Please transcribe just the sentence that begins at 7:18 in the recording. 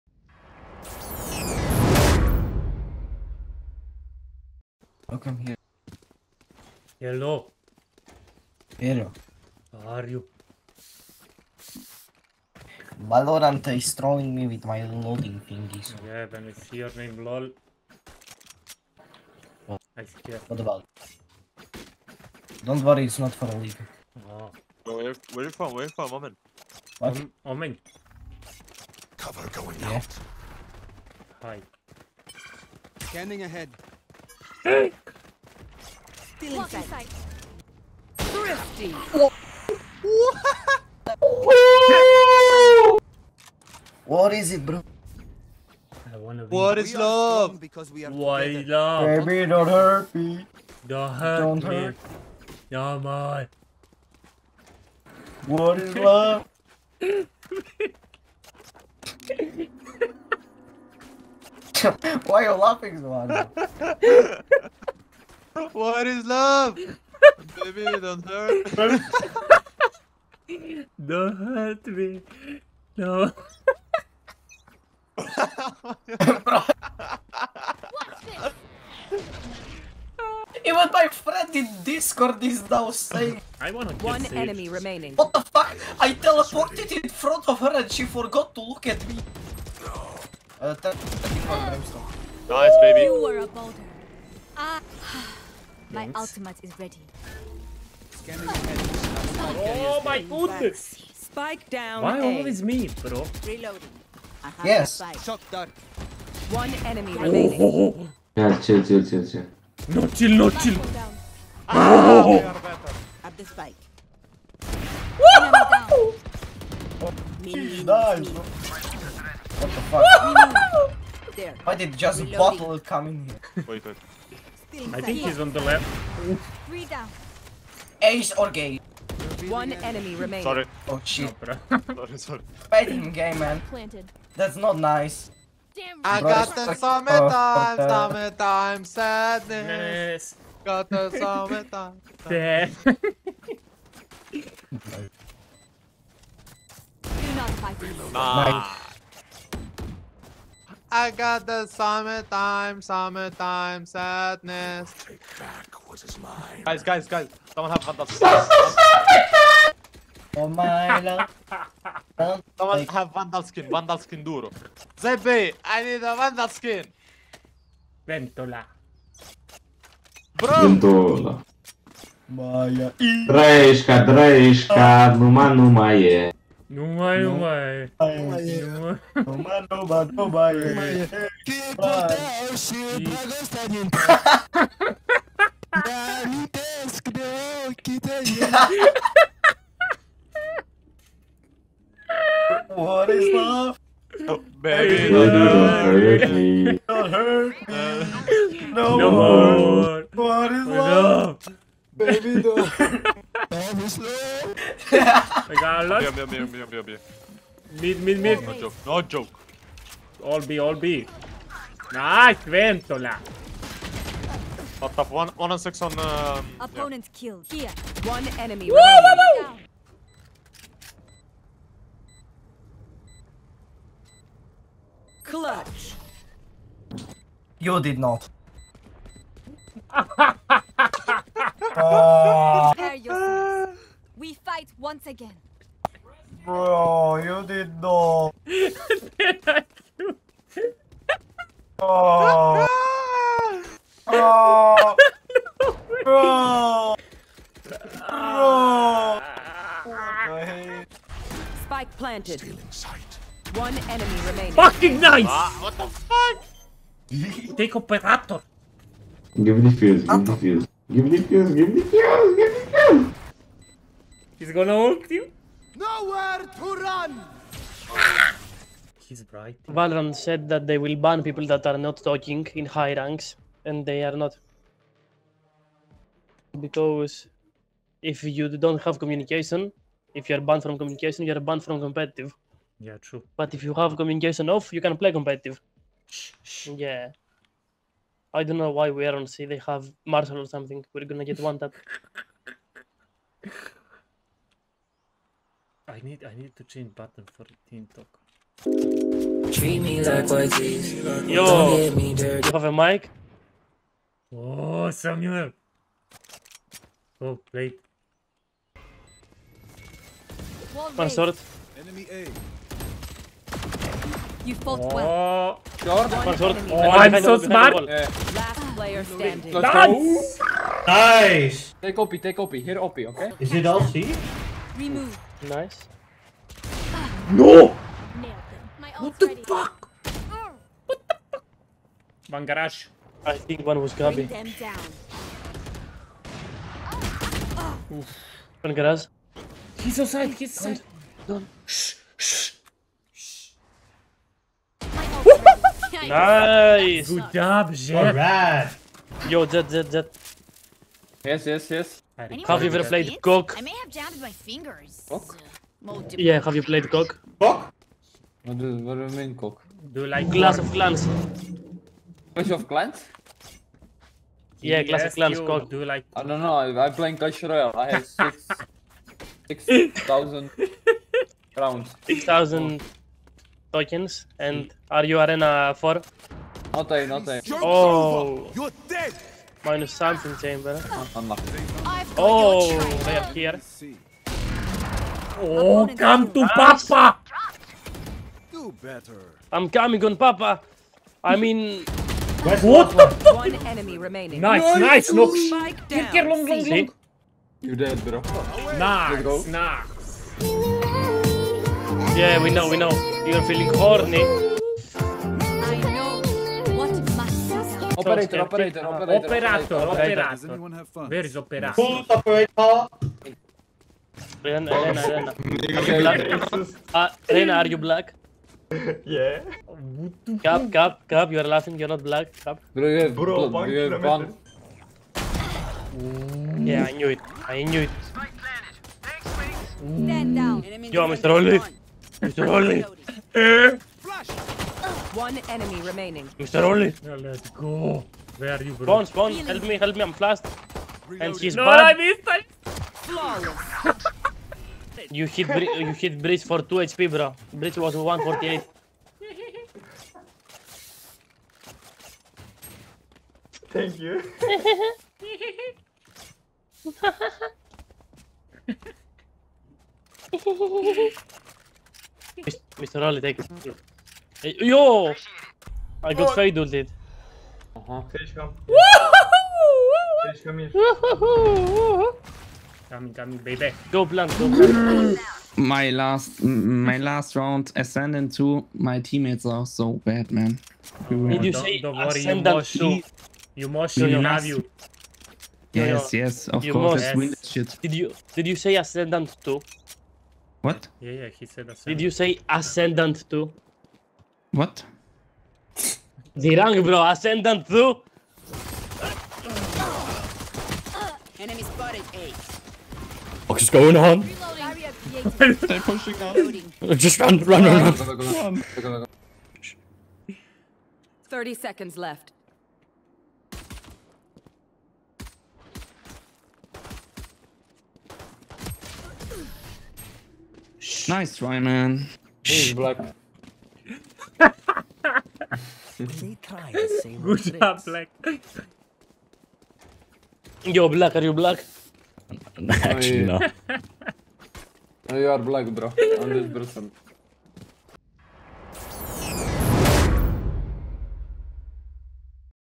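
Bones, Bones, help me, help me.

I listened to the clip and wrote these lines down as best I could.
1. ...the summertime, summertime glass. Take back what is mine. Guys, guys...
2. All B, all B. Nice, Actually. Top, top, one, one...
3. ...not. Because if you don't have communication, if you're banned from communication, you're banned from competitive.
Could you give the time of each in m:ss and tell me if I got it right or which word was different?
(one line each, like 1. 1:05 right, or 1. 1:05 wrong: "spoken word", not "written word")
1. 2:31 wrong: "sadness", not "glass"
2. 3:30 wrong: "Ventola", not "Actually"
3. 4:34 right.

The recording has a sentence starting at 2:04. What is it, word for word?
I think he's on the left.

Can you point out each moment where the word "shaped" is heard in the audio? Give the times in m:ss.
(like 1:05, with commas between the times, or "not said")
not said.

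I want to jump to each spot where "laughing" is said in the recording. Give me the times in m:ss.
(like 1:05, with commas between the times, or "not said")
1:02, 7:01.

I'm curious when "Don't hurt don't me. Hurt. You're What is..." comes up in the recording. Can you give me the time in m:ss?
0:50.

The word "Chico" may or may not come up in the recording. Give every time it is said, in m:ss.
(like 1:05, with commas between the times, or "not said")
3:02.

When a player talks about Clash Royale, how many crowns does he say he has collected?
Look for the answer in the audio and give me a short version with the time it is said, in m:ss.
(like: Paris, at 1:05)
6,000, at 6:09.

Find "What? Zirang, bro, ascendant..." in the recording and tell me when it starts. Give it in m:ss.
8:14.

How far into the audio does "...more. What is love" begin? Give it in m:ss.
3:19.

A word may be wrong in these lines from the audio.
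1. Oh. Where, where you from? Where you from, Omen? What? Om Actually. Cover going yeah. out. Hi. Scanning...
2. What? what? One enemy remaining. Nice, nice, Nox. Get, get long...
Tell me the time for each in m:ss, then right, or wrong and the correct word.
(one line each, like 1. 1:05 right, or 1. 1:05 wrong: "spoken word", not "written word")
1. 0:24 wrong: "Omen", not "Actually"
2. 6:32 right.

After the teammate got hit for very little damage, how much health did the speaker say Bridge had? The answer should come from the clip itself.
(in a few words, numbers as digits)
148.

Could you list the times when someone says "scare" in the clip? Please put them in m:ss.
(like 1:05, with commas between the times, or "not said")
0:20.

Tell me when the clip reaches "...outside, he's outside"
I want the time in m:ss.
5:39.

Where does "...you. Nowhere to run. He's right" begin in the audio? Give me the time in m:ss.
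4:25.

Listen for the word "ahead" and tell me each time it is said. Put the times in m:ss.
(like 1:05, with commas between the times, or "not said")
0:33.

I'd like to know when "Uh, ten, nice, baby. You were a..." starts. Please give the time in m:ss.
1:30.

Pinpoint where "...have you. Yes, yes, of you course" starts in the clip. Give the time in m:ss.
8:04.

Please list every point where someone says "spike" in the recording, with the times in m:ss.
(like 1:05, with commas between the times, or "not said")
1:41, 1:53, 4:11.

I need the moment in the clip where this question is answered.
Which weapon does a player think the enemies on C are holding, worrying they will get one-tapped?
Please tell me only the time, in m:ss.
4:50.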